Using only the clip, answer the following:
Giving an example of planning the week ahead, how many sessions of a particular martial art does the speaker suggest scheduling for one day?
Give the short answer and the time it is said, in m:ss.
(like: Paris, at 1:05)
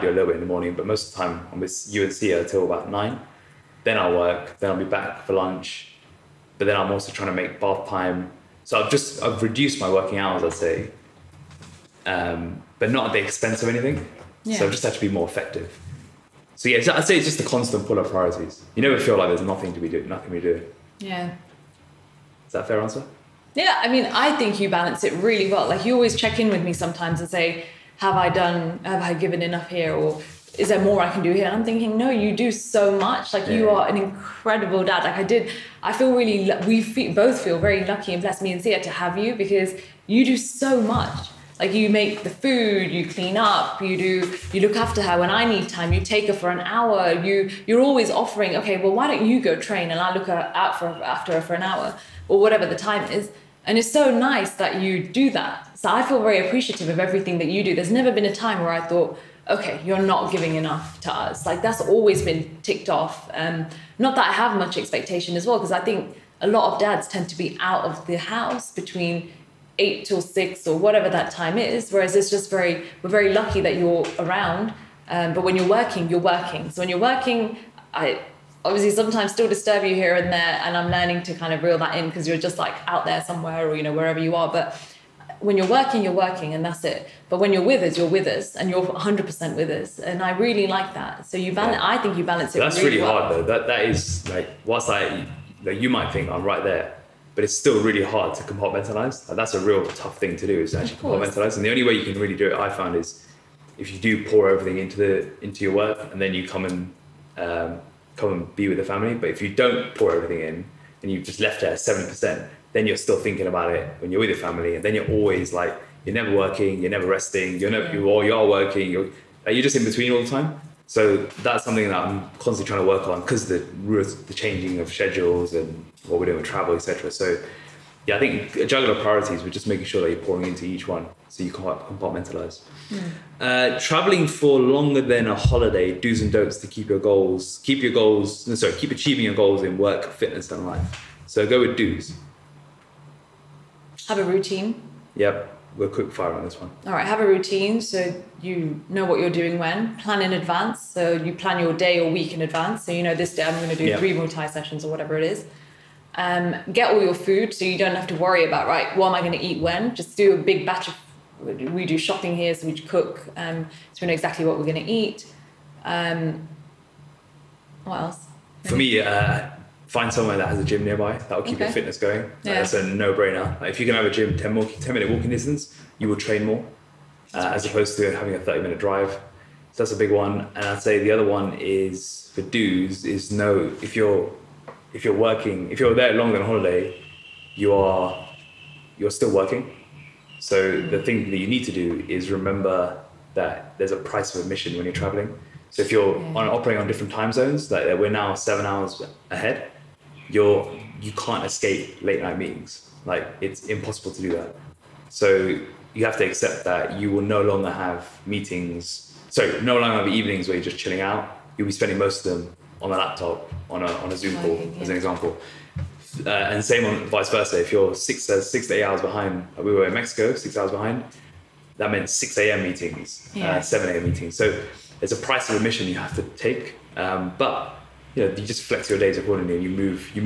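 3, at 2:33.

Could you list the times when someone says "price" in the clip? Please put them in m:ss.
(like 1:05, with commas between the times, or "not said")
3:13, 3:45.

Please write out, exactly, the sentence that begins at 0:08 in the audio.
So I've just I've reduced my working hours, I'd say, um, but not at the expense of anything.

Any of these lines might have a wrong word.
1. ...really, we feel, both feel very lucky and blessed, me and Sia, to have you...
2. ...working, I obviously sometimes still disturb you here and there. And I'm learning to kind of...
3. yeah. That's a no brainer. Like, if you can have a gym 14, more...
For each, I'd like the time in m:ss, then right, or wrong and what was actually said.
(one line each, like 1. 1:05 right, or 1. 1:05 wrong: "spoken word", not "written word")
1. 0:36 right
2. 1:16 right
3. 2:52 wrong: "10", not "14".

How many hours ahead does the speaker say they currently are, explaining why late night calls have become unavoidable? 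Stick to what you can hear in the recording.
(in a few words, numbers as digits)
7.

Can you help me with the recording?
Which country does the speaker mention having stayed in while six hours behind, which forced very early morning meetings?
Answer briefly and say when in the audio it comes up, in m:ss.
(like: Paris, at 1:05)
Mexico, at 3:39.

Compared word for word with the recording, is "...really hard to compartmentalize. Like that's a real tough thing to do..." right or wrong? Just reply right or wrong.
right.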